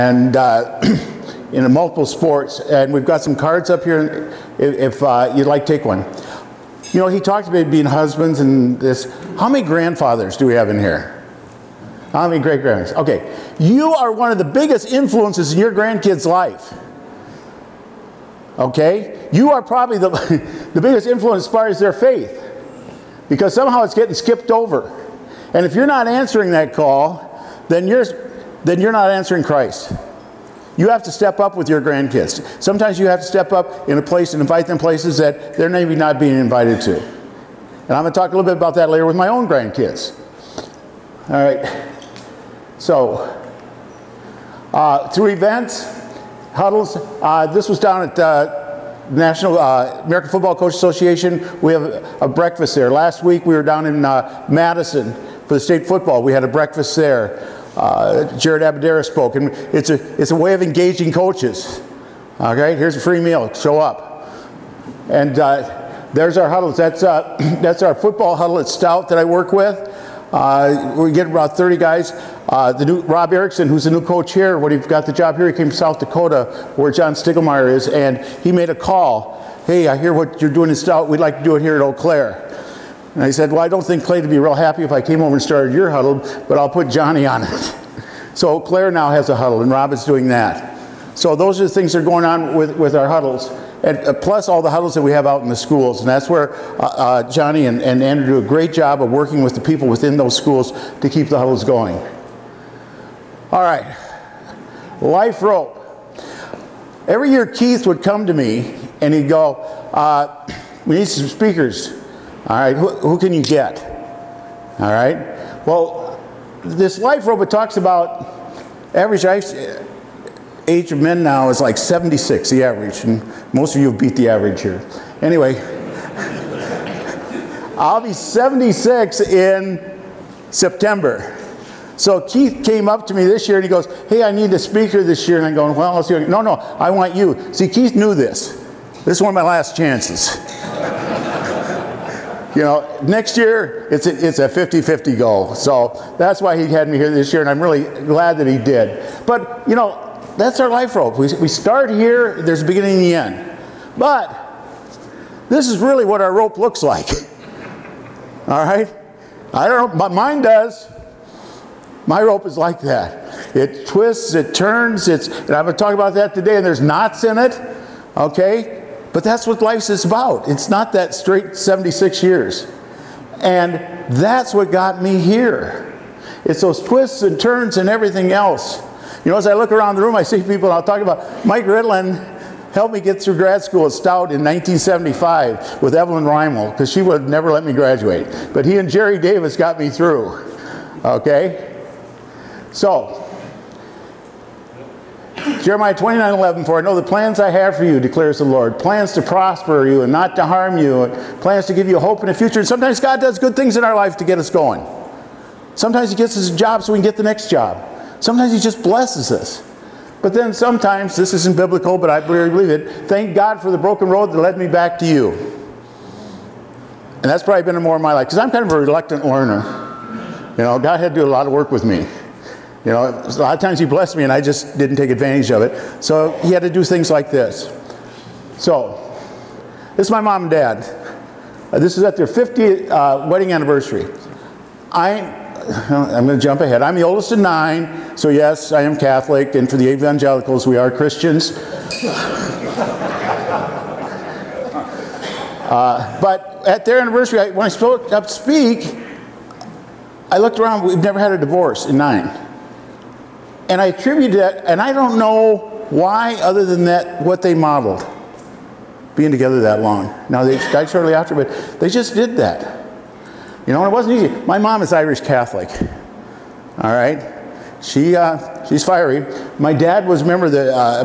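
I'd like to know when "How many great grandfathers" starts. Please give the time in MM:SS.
00:12.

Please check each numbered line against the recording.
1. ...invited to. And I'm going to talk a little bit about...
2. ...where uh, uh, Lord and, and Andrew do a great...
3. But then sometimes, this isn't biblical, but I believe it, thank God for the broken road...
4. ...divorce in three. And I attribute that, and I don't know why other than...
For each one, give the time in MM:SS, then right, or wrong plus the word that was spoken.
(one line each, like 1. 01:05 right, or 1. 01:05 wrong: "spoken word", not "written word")
1. 00:36 right
2. 01:36 wrong: "Johnny", not "Lord"
3. 03:30 right
4. 04:11 wrong: "nine", not "three".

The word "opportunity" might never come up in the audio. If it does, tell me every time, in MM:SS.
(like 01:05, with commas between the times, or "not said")
not said.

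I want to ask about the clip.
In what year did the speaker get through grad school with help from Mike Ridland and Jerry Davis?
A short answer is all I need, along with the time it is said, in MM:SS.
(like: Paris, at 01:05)
1975, at 03:04.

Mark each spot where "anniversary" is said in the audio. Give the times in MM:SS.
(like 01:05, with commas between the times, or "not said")
03:53, 04:07.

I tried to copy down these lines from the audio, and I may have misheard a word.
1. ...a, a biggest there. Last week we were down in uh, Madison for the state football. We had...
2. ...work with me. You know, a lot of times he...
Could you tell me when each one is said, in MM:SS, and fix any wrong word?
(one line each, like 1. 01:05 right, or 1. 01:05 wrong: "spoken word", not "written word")
1. 00:51 wrong: "breakfast", not "biggest"
2. 03:41 right.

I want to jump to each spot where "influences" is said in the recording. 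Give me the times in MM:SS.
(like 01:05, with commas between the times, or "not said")
00:14, 00:21.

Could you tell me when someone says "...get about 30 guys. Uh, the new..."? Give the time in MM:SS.
01:11.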